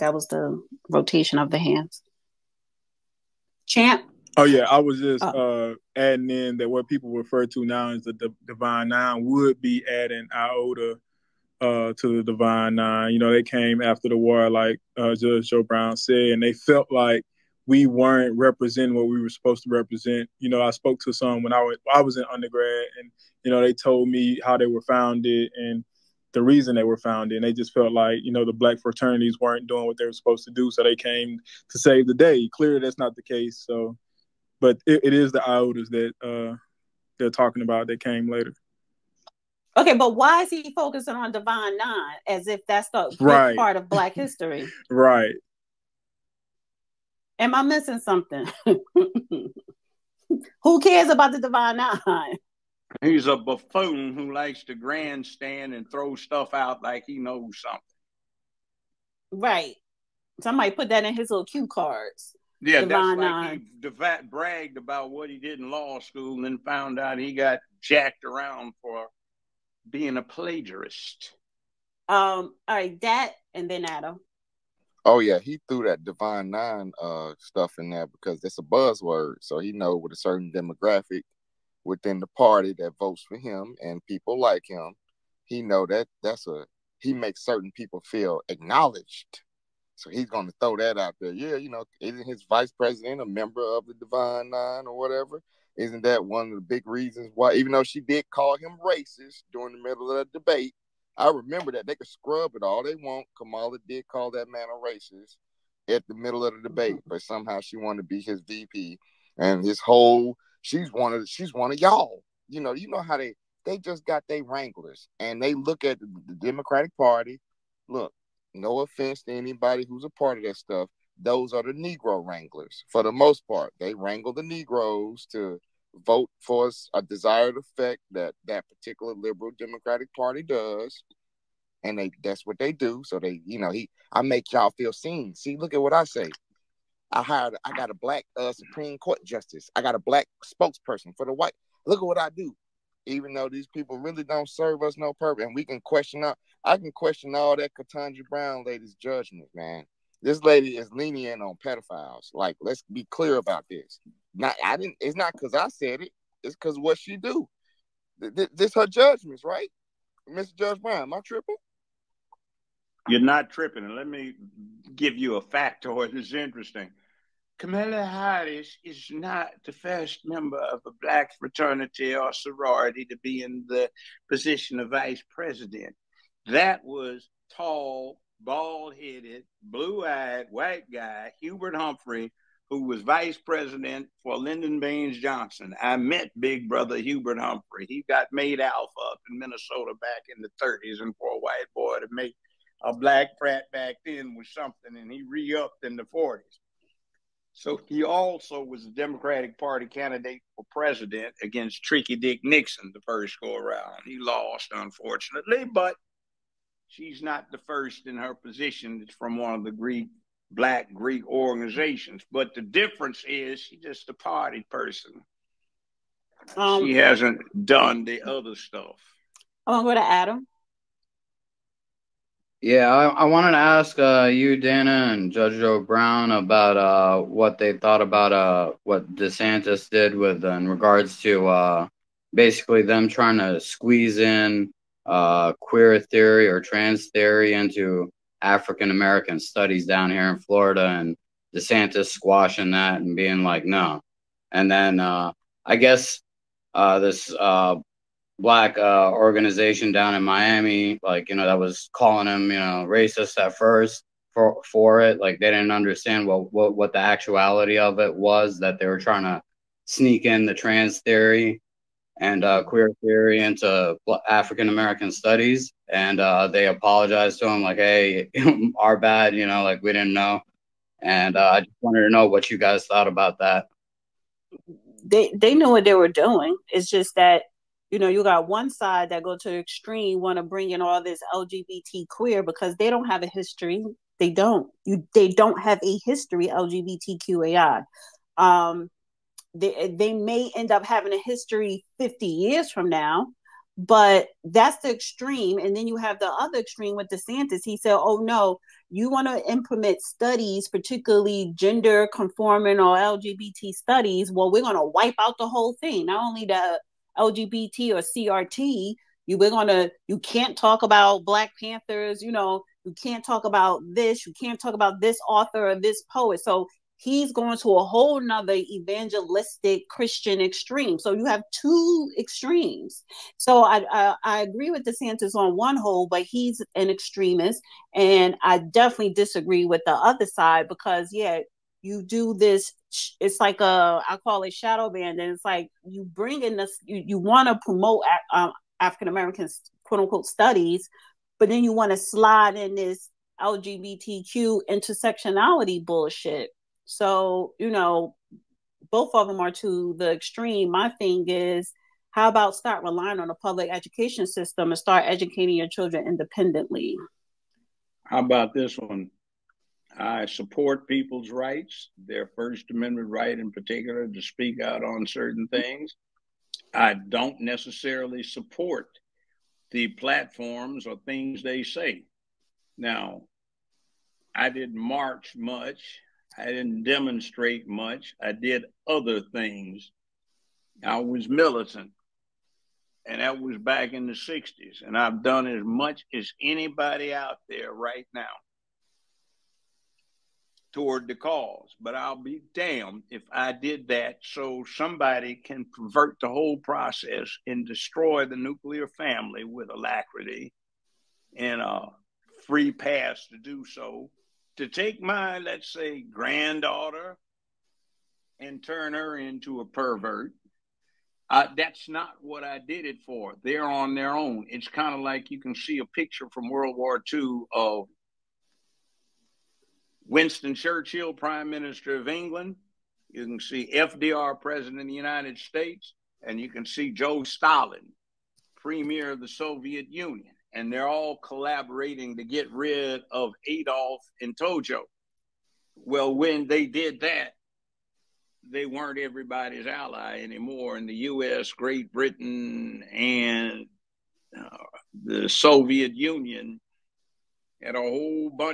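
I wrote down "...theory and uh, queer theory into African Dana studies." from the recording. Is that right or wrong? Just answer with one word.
wrong.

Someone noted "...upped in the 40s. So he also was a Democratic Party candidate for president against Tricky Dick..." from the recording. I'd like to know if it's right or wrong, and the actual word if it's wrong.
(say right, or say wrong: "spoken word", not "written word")
right.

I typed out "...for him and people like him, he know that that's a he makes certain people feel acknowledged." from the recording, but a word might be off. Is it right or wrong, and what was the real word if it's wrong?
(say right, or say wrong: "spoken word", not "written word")
right.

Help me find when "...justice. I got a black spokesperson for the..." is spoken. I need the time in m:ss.
2:19.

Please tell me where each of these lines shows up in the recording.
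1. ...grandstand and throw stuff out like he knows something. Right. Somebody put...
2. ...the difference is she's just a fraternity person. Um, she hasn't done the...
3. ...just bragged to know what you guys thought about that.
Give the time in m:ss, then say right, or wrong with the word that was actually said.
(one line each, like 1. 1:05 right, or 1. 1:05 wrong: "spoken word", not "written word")
1. 0:54 right
2. 3:32 wrong: "party", not "fraternity"
3. 4:31 wrong: "wanted", not "bragged".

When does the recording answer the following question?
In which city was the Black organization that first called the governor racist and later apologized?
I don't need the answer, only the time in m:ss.
4:10.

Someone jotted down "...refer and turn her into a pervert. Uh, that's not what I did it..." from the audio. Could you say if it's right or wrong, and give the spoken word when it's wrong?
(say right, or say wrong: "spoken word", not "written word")
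wrong: "granddaughter", not "refer".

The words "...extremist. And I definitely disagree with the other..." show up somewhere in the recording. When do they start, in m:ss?
5:26.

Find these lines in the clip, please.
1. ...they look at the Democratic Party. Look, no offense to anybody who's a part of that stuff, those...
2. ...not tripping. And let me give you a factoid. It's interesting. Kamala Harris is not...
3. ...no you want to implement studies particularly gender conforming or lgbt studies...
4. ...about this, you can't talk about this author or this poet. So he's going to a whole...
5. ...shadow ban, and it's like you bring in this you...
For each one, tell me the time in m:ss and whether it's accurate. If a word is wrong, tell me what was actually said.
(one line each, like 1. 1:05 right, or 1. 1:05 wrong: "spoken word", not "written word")
1. 1:55 right
2. 2:43 right
3. 4:58 right
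4. 5:13 right
5. 5:34 right.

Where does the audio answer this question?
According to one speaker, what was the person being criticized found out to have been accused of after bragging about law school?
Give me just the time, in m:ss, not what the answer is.
1:10.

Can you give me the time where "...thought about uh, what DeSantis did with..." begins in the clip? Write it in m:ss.
3:47.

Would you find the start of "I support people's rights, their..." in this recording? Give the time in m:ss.
5:59.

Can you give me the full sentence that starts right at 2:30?
This lady is lenient on pedophiles.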